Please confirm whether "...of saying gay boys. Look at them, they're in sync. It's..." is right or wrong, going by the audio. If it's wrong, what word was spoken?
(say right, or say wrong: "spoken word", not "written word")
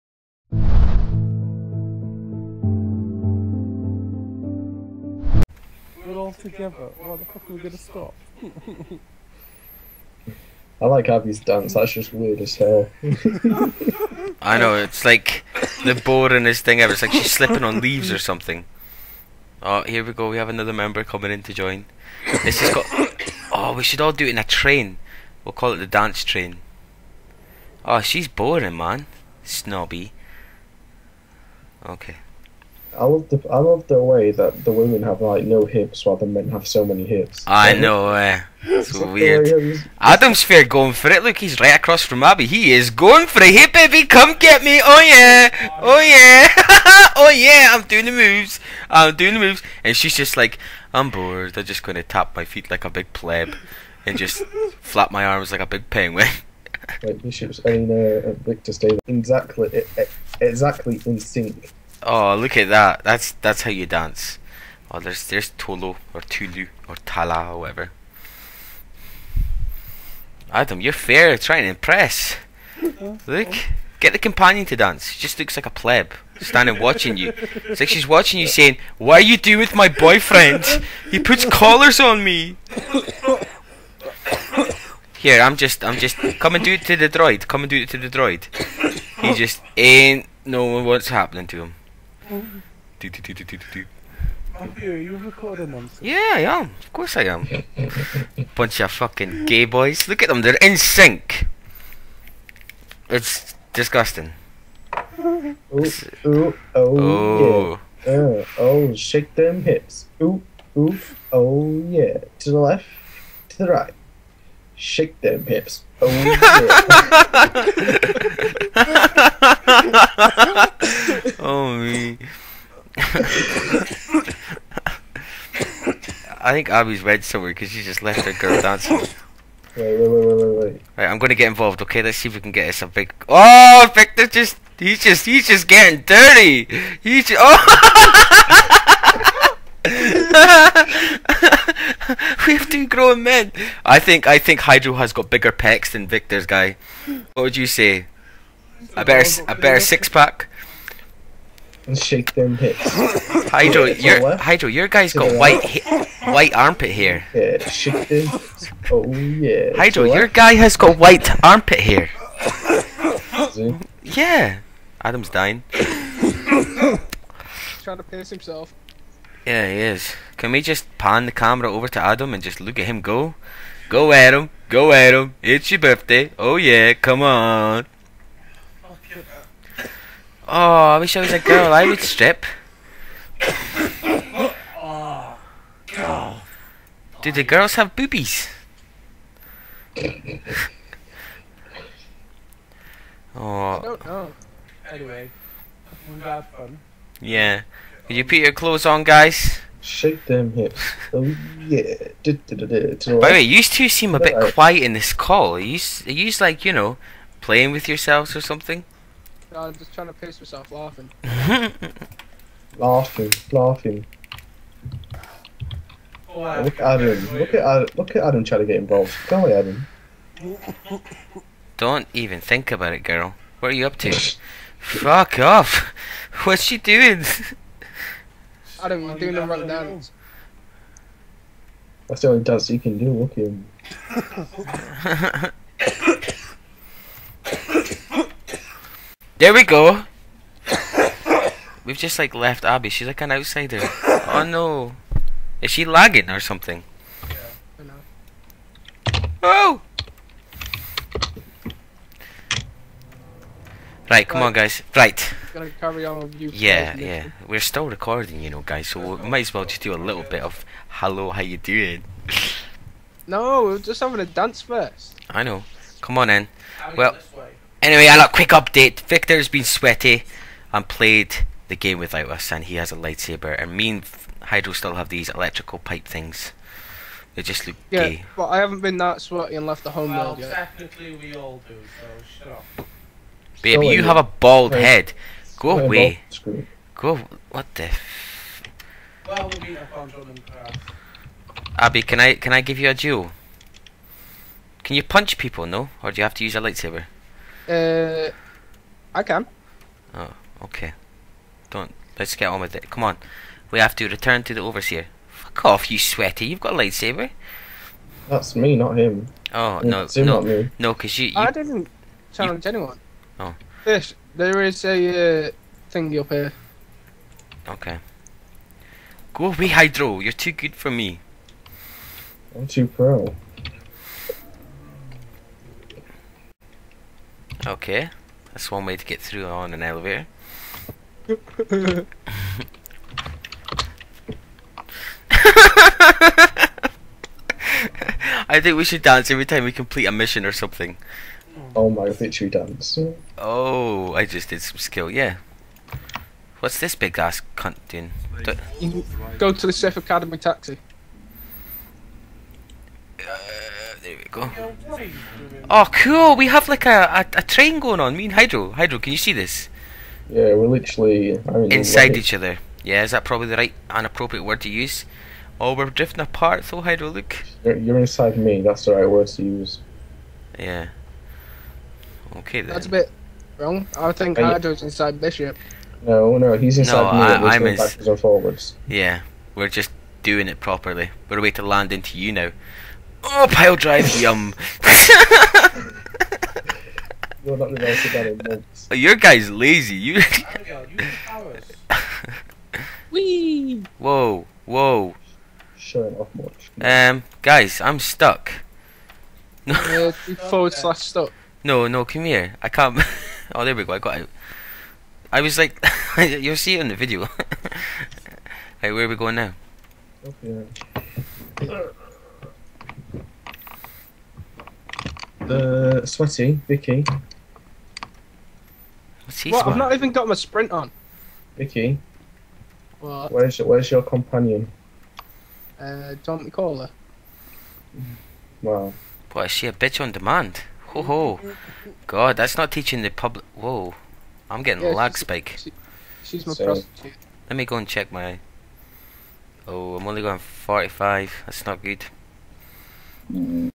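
wrong: "fucking", not "saying".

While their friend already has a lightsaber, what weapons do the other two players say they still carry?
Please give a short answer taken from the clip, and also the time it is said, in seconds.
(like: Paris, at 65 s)
electrical pipe things, at 275 s.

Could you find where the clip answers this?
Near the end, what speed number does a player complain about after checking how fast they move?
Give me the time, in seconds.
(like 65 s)
440 s.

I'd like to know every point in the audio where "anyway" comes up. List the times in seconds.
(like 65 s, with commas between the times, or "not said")
194 s, 267 s.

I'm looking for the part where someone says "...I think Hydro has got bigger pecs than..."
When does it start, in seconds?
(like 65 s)
144 s.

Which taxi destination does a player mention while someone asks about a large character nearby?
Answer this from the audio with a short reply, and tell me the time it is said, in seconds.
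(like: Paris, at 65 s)
Chef Academy, at 349 s.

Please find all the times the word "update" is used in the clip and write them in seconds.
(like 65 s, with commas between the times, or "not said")
268 s.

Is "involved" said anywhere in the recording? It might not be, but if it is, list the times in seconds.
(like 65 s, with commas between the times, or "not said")
131 s, 218 s.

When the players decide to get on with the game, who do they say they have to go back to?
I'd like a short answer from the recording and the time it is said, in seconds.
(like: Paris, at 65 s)
the overseer, at 304 s.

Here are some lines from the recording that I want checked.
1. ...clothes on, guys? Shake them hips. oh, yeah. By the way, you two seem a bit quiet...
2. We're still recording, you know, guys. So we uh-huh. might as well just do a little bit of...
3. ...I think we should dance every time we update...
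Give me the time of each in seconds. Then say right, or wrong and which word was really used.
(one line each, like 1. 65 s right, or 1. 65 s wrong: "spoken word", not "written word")
1. 198 s right
2. 257 s right
3. 338 s wrong: "complete", not "update".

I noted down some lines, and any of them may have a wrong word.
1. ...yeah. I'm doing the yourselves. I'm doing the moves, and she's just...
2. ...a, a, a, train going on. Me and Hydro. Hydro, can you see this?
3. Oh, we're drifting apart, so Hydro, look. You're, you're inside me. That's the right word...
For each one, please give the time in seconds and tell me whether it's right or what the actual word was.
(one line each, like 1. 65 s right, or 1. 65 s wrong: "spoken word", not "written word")
1. 47 s wrong: "moves", not "yourselves"
2. 356 s right
3. 365 s right.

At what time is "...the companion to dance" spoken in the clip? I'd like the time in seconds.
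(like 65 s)
74 s.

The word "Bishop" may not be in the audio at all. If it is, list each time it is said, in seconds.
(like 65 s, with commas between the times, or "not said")
57 s, 375 s.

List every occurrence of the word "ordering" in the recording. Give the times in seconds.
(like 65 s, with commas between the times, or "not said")
not said.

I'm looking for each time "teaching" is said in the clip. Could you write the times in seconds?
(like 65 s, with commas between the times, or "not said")
432 s.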